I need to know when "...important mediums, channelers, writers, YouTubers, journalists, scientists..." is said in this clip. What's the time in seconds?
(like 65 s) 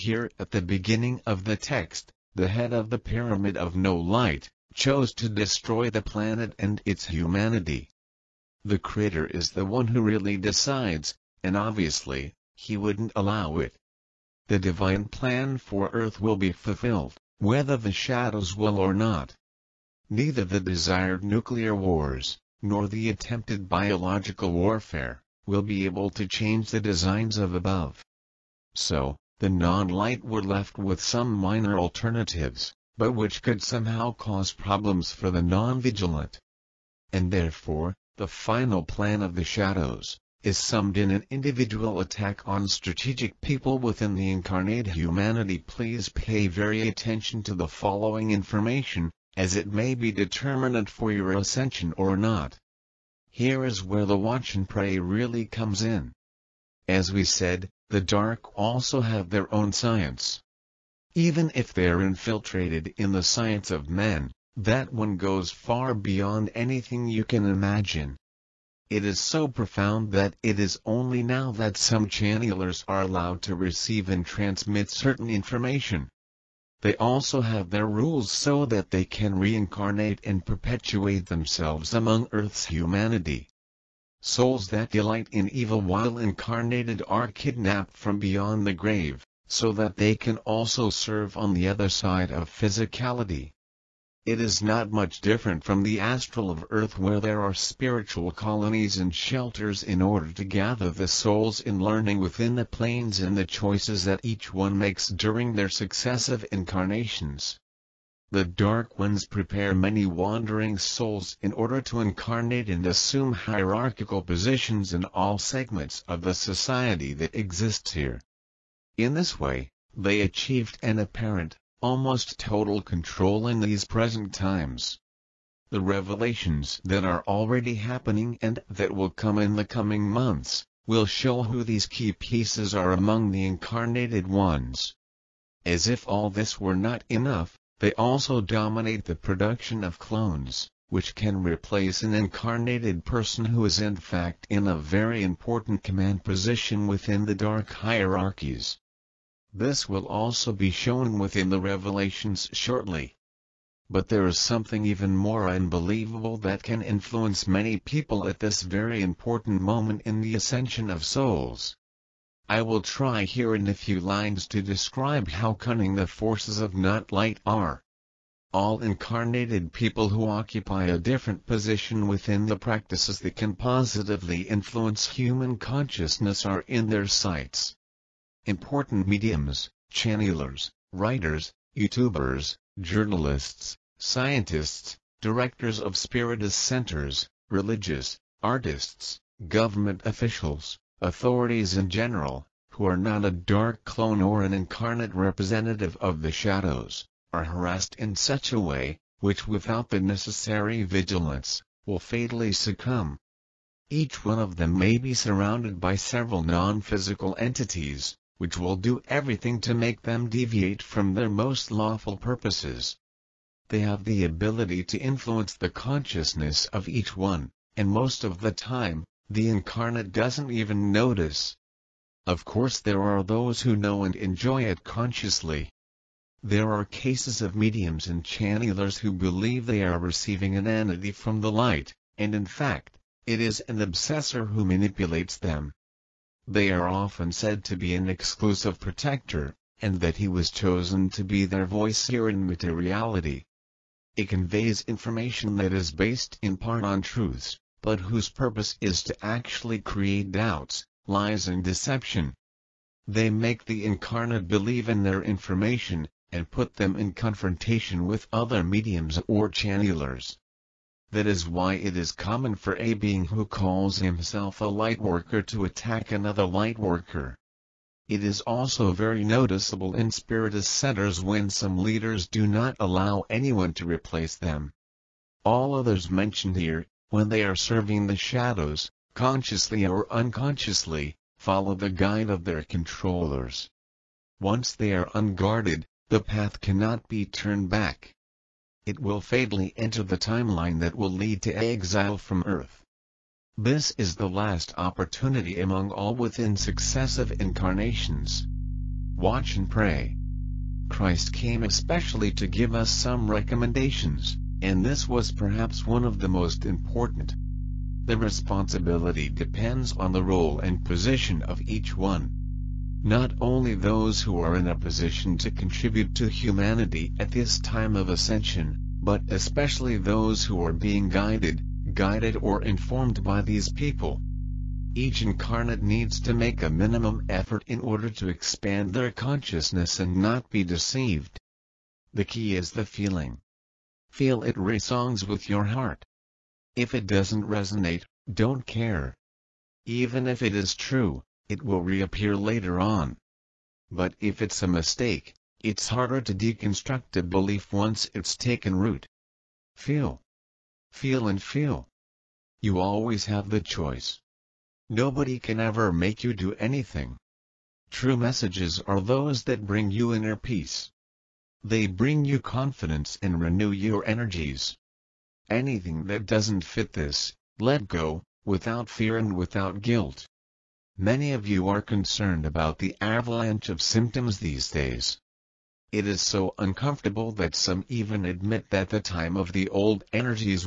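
178 s.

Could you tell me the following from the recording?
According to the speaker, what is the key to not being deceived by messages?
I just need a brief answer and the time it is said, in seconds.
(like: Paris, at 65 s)
the feeling, at 332 s.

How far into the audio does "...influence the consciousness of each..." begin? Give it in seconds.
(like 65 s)
214 s.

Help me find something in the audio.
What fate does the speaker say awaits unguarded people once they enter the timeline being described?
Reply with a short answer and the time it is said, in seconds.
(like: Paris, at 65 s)
exile from Earth, at 291 s.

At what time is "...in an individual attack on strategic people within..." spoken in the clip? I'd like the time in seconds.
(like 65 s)
40 s.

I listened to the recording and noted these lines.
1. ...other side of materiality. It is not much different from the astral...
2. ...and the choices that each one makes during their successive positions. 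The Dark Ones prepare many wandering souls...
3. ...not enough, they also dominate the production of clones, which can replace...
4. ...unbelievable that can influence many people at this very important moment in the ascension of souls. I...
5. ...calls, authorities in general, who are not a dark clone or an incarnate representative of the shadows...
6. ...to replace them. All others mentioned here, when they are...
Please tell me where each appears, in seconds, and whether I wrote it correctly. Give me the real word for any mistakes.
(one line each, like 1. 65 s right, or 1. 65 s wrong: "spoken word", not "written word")
1. 91 s wrong: "physicality", not "materiality"
2. 103 s wrong: "incarnations", not "positions"
3. 136 s right
4. 155 s right
5. 190 s wrong: "officials", not "calls"
6. 273 s right.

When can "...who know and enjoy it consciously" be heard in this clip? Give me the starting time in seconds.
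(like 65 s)
223 s.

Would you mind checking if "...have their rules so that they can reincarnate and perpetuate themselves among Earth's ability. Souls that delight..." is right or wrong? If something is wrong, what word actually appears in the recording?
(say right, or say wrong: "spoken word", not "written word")
wrong: "humanity", not "ability".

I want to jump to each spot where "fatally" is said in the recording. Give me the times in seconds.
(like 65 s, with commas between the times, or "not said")
201 s, 289 s.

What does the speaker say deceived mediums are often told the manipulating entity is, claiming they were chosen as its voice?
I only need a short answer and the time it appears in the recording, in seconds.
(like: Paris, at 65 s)
an exclusive protector, at 238 s.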